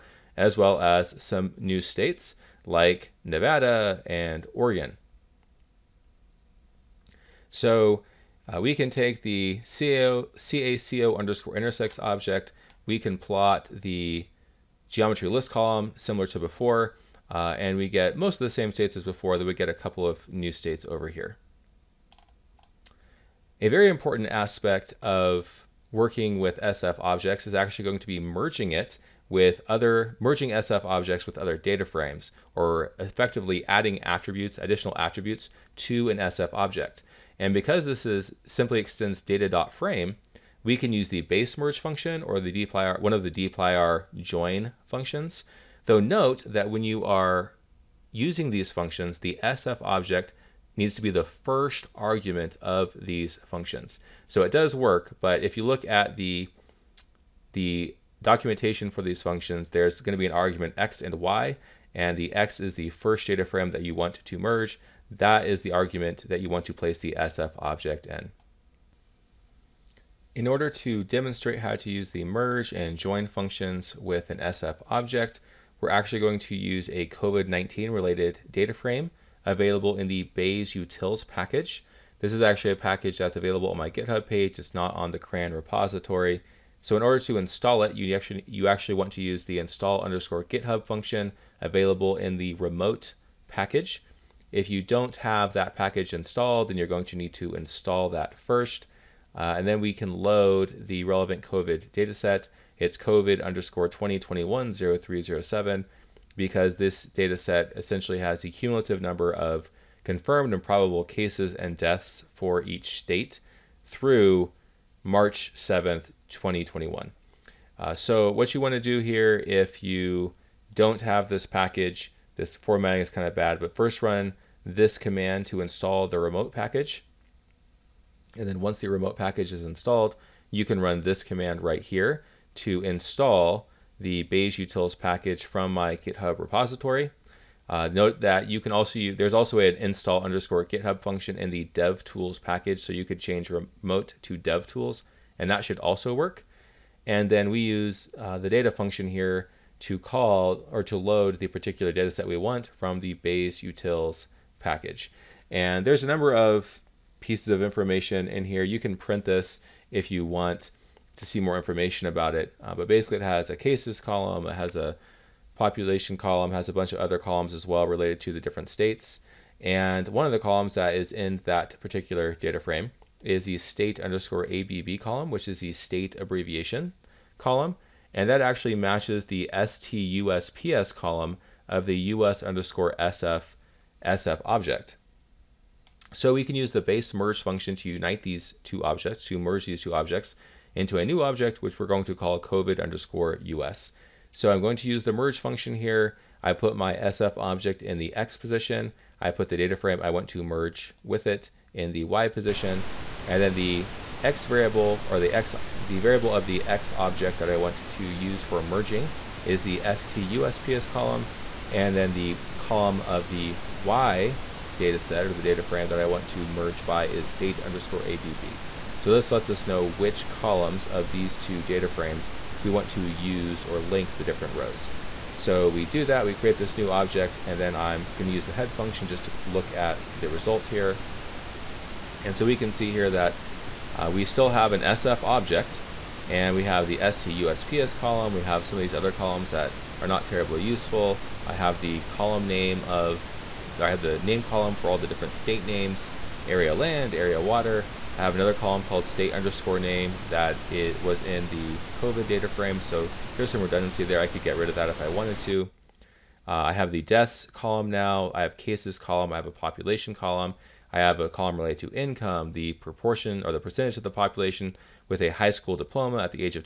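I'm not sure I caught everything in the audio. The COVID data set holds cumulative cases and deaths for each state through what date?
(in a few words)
March 7th, 2021.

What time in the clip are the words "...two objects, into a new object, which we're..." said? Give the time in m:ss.
3:09.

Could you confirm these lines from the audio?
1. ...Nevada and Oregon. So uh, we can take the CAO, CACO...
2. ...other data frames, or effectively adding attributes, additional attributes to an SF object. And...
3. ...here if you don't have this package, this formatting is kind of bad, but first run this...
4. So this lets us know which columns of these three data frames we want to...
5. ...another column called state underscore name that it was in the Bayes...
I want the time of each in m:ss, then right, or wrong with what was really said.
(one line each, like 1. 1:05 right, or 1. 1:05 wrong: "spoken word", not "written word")
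1. 0:03 right
2. 0:31 right
3. 1:59 right
4. 3:39 wrong: "two", not "three"
5. 4:08 wrong: "COVID", not "Bayes".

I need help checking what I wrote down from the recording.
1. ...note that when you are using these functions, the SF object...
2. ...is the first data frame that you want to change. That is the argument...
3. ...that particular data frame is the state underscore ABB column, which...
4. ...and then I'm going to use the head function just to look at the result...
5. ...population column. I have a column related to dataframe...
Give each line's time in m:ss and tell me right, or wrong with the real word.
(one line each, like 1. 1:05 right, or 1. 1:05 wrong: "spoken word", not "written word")
1. 0:45 right
2. 1:02 wrong: "merge", not "change"
3. 2:51 right
4. 3:47 right
5. 4:19 wrong: "income", not "dataframe".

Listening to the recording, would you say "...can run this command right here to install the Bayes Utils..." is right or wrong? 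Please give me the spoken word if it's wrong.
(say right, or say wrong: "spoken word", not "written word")
right.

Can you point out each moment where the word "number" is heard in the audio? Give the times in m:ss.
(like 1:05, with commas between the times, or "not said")
1:49, 2:36.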